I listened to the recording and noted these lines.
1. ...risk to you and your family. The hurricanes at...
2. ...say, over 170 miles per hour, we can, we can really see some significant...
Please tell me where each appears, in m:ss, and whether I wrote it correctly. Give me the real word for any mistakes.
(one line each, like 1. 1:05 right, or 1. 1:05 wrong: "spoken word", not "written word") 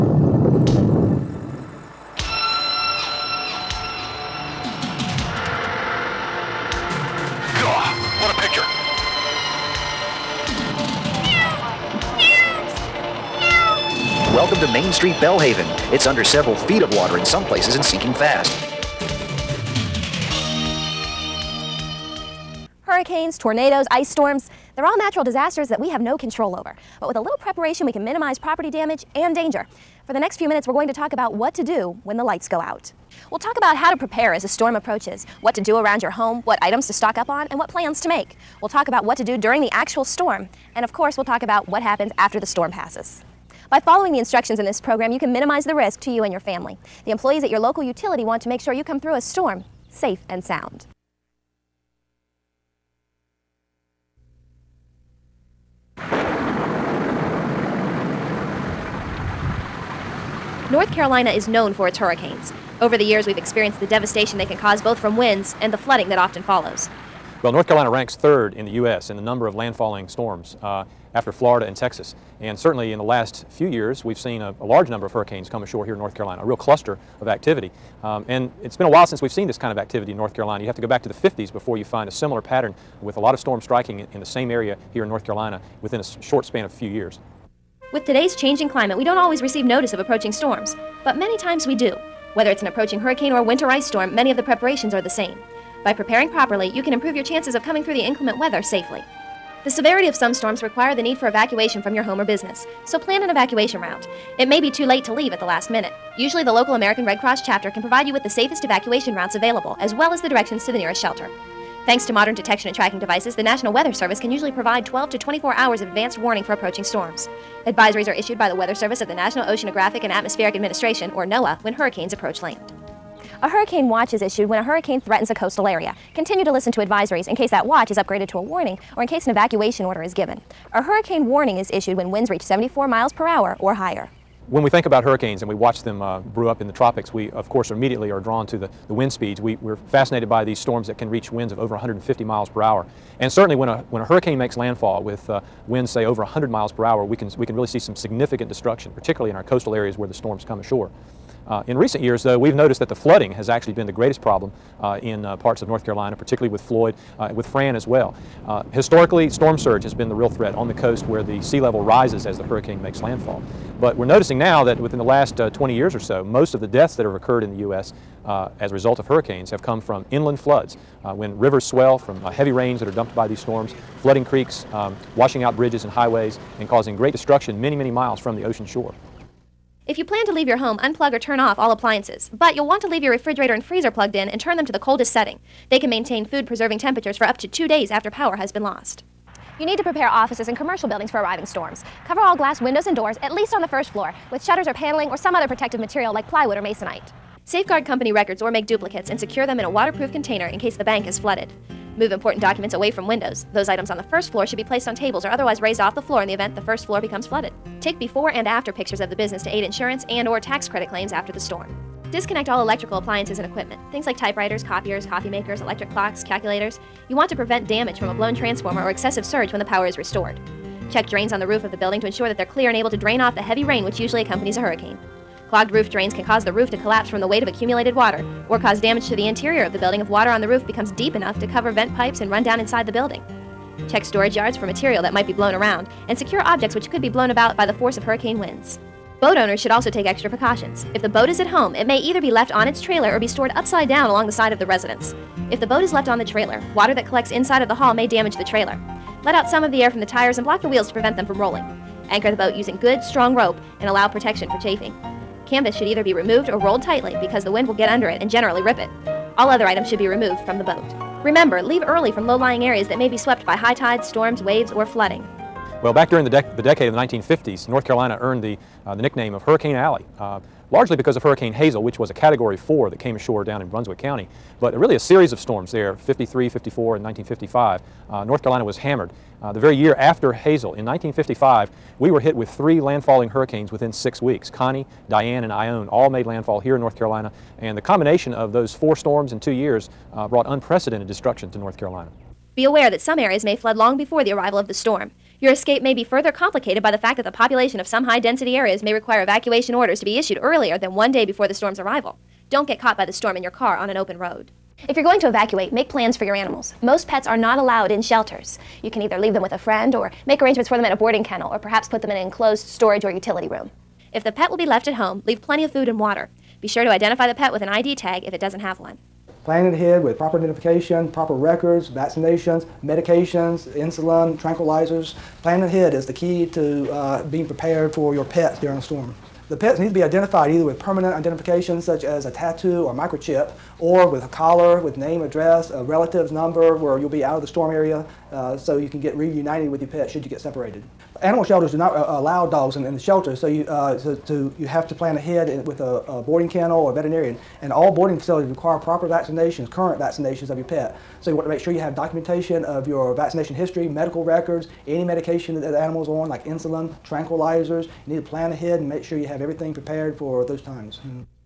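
1. 0:45 wrong: "employees", not "hurricanes"
2. 2:25 wrong: "100", not "170".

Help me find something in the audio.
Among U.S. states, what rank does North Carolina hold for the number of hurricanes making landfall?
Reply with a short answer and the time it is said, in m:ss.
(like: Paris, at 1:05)
third, at 1:08.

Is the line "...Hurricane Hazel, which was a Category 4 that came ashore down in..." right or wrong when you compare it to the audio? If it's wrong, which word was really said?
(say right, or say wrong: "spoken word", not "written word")
right.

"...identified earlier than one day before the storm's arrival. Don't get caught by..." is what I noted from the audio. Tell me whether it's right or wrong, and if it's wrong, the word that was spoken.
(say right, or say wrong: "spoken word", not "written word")
wrong: "issued", not "identified".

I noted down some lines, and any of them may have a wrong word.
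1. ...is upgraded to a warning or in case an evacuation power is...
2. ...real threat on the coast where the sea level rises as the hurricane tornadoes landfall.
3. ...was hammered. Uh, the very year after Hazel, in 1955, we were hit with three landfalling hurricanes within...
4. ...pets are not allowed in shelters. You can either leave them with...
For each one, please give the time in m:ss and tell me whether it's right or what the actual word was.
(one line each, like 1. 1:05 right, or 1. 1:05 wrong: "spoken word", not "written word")
1. 2:07 wrong: "order", not "power"
2. 2:40 wrong: "makes", not "tornadoes"
3. 4:38 right
4. 5:07 right.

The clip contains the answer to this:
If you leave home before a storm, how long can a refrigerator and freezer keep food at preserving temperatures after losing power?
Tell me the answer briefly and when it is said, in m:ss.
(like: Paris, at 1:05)
two days, at 3:07.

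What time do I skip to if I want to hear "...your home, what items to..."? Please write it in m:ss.
0:36.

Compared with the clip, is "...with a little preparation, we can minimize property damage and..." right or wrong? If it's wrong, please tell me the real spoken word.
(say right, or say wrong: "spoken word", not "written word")
right.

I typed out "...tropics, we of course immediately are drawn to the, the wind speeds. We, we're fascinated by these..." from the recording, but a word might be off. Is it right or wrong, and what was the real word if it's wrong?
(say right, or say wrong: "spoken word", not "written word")
right.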